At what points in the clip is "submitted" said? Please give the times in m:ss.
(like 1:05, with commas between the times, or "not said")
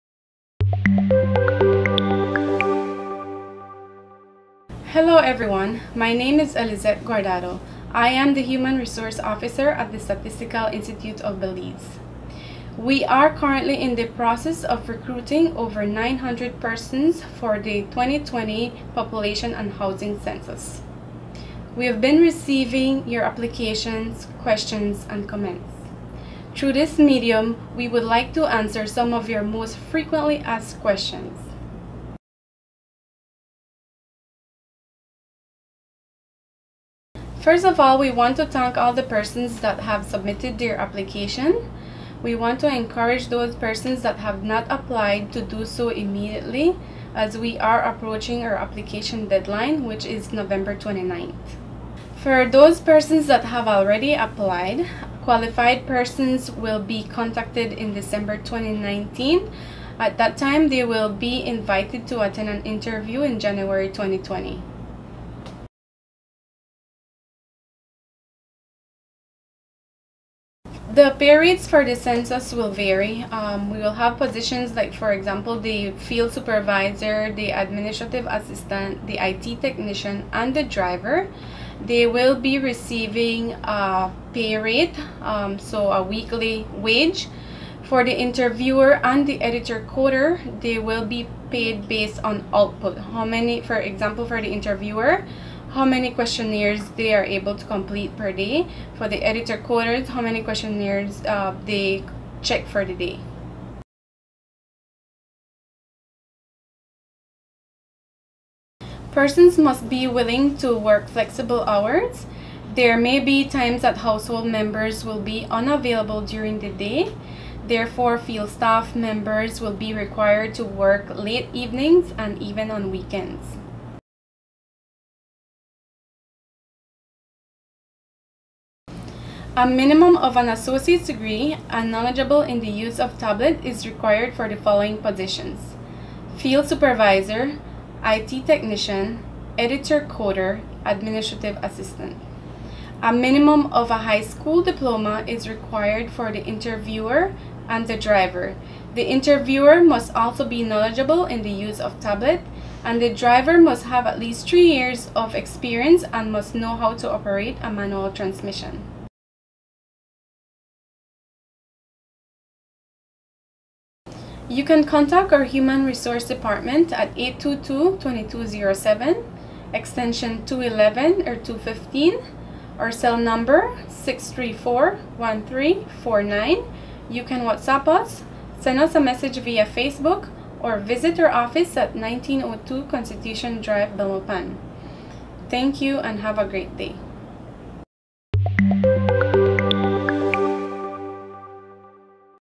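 0:40.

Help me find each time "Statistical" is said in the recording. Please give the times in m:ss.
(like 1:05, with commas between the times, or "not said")
0:10.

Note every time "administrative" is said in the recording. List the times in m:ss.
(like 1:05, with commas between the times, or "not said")
1:17, 2:20.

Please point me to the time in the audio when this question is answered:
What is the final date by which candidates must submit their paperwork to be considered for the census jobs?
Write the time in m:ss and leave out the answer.
0:50.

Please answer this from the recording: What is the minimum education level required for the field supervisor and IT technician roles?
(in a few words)
associate's degree.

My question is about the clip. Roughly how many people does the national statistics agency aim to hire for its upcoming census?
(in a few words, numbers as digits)
over 900.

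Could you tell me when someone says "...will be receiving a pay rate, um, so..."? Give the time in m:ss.
1:22.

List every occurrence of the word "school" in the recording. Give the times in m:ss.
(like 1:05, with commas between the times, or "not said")
2:24.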